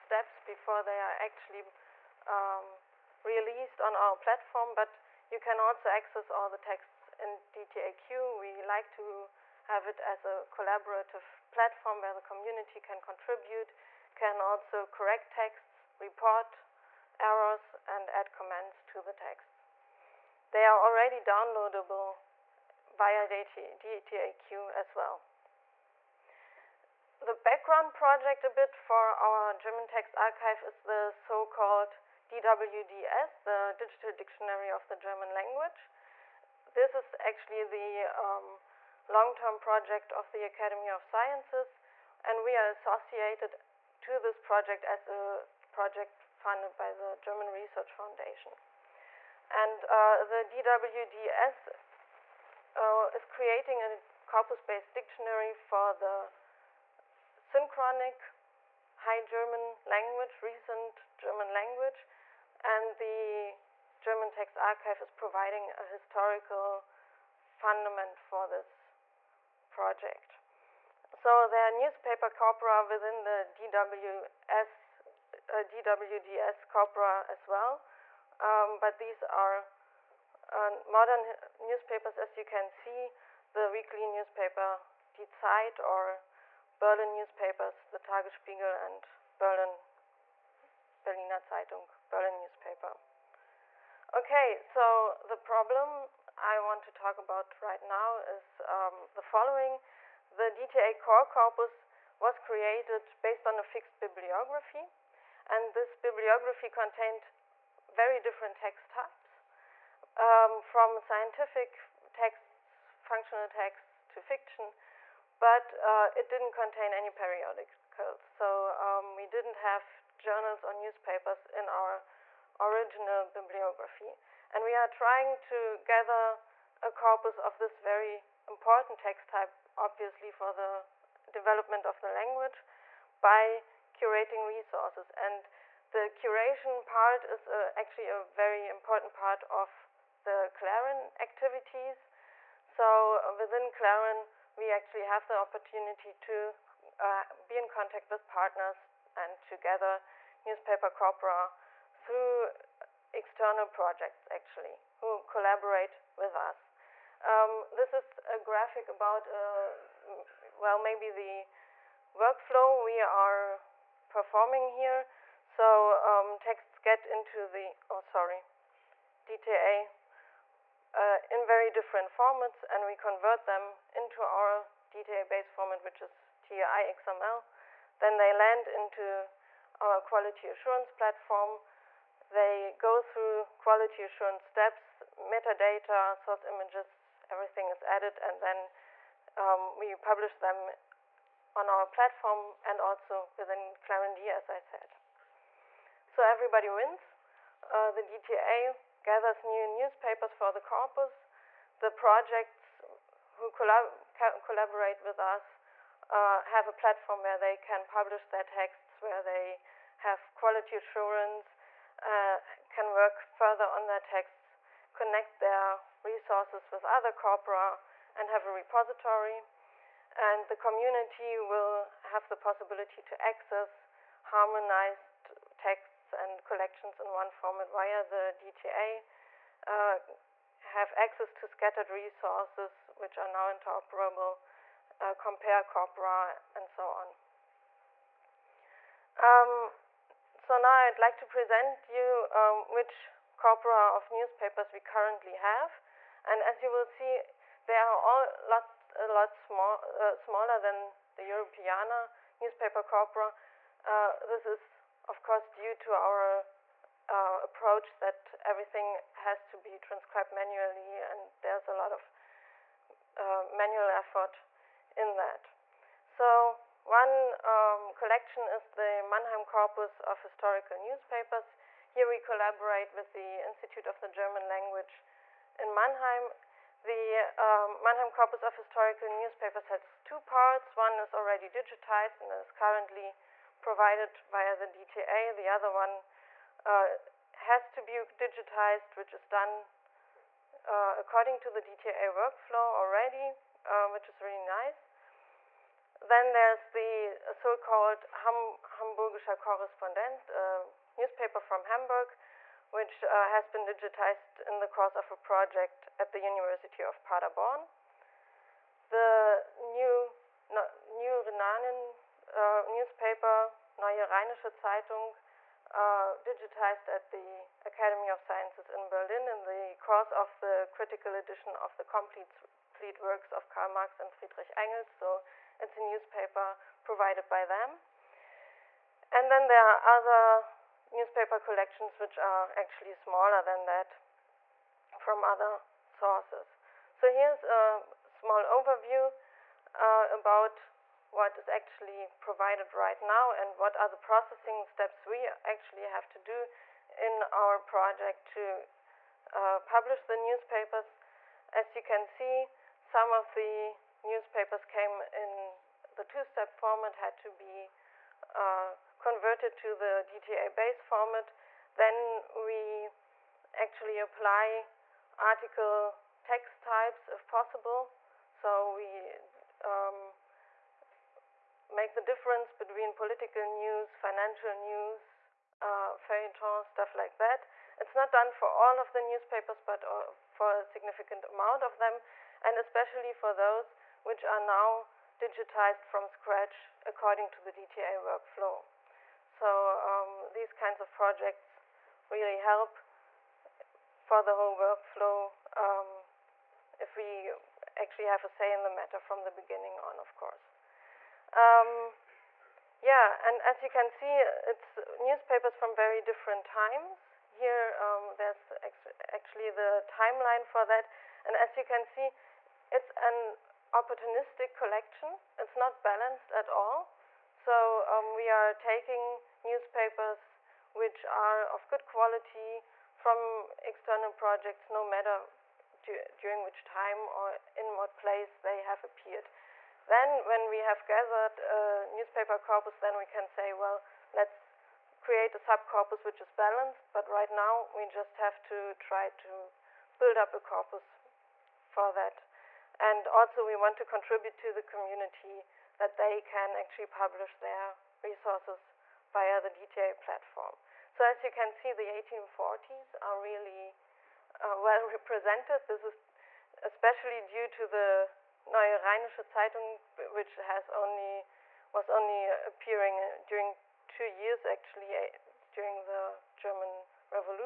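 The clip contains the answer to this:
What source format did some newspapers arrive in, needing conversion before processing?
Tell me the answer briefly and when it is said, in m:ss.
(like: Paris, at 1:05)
TUSTEP, at 5:56.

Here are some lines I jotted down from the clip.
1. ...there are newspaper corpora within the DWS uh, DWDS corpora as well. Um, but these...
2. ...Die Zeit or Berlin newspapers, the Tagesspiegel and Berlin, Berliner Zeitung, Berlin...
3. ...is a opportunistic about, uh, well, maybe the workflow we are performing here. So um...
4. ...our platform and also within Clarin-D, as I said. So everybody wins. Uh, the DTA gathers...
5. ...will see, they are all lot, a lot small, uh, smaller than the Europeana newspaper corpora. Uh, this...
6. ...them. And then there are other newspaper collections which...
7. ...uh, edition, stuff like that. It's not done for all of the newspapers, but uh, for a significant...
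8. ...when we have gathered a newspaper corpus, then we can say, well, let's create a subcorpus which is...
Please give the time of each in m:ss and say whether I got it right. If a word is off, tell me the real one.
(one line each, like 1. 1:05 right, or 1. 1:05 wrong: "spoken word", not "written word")
1. 1:11 right
2. 1:25 right
3. 2:37 wrong: "graphic", not "opportunistic"
4. 3:11 right
5. 4:06 right
6. 5:27 right
7. 6:15 wrong: "feuilleton", not "edition"
8. 7:10 right.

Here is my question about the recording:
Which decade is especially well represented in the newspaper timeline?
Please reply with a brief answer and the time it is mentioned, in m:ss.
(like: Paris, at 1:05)
1840s, at 7:31.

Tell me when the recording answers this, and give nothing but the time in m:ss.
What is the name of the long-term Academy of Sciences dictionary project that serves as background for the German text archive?
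0:33.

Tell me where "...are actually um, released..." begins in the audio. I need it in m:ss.
0:00.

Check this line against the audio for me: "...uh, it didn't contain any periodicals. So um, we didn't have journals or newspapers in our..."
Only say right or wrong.
right.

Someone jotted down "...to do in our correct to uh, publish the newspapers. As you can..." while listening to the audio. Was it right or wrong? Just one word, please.
wrong.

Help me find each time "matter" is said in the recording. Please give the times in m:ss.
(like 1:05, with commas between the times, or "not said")
6:38, 7:04.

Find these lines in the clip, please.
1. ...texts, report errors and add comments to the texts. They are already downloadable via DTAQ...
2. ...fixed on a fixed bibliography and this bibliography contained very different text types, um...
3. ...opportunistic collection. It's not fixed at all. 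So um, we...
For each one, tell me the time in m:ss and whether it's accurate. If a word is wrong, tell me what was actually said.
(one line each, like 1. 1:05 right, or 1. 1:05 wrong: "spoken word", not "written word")
1. 0:15 right
2. 1:43 wrong: "based", not "fixed"
3. 6:53 wrong: "balanced", not "fixed".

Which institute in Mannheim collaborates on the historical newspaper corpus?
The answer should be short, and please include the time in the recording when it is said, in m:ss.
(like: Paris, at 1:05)
Institute of the German Language, at 4:33.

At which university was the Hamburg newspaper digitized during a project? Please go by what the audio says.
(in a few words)
University of Paderborn.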